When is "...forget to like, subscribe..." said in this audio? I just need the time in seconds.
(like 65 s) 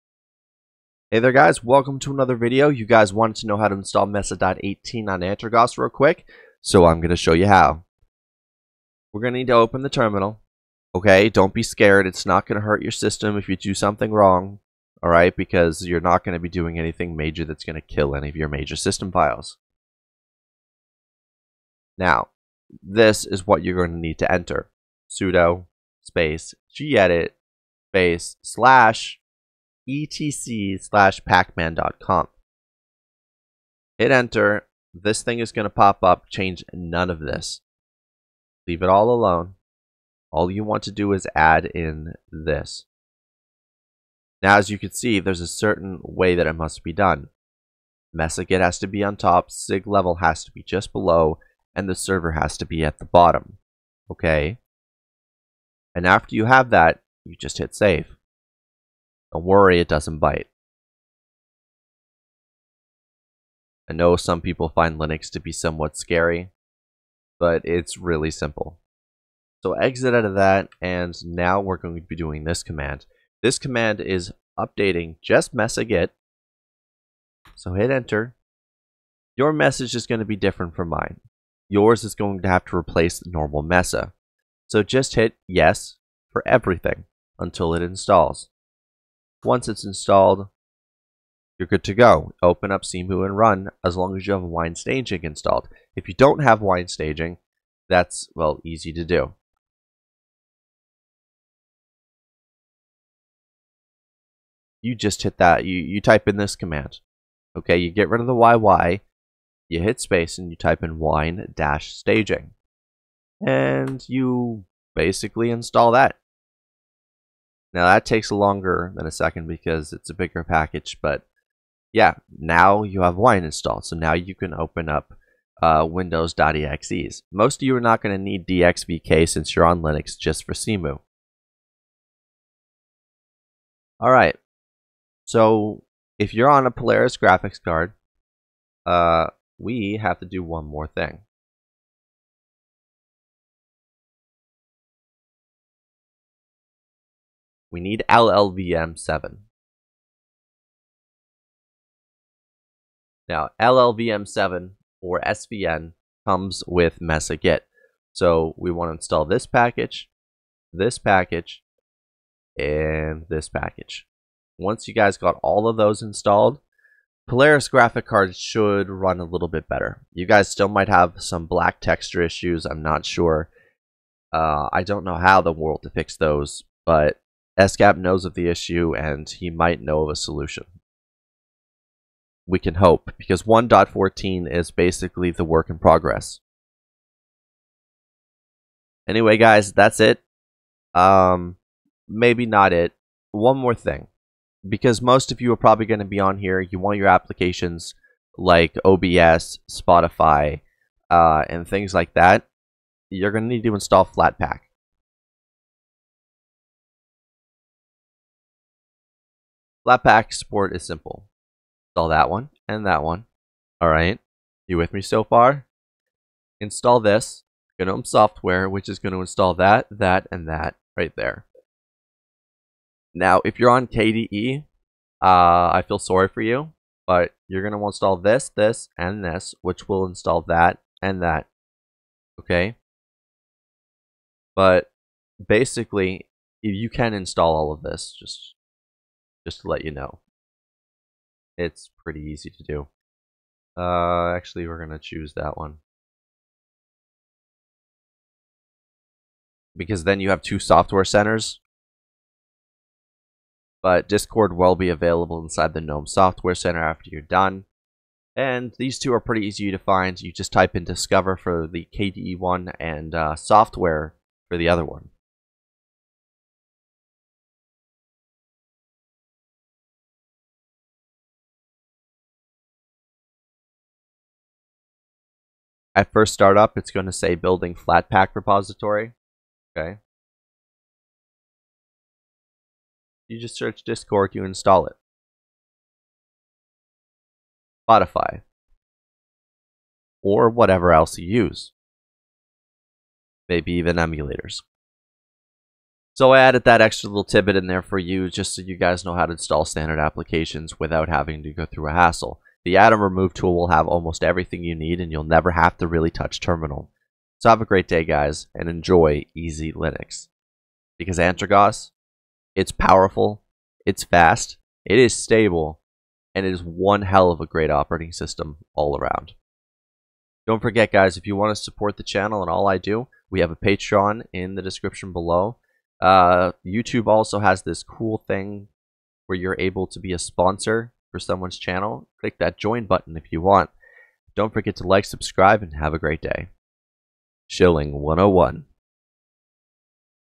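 334 s.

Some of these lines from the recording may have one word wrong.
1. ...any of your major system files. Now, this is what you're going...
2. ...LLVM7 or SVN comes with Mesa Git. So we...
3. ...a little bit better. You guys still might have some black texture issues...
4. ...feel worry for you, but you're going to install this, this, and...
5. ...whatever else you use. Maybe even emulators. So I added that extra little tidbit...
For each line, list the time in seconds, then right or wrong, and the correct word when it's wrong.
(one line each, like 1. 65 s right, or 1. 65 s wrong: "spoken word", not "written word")
1. 18 s right
2. 153 s right
3. 169 s right
4. 225 s wrong: "sorry", not "worry"
5. 290 s right.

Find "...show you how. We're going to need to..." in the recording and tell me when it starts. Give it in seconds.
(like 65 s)
7 s.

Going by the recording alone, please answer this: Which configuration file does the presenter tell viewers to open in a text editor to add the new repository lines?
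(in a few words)
pacman.conf.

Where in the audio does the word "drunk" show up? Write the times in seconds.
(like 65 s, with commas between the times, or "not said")
not said.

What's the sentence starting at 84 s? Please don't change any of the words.
So just hit yes for everything until it installs.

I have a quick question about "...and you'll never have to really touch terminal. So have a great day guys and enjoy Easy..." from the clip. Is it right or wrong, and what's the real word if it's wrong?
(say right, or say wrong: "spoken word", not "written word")
right.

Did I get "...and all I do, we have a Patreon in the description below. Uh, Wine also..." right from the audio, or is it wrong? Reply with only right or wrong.
wrong.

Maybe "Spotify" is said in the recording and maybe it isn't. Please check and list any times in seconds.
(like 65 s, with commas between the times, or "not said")
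199 s, 287 s.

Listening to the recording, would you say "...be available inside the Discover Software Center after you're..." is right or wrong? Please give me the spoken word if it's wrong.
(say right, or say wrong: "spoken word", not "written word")
wrong: "GNOME", not "Discover".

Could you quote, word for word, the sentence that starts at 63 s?
I know some people find Linux to be somewhat scary, but it's really simple.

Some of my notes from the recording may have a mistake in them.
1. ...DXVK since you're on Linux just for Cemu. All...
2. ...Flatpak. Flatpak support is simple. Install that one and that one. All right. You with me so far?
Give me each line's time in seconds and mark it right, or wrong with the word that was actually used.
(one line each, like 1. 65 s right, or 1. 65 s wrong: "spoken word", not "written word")
1. 128 s right
2. 204 s right.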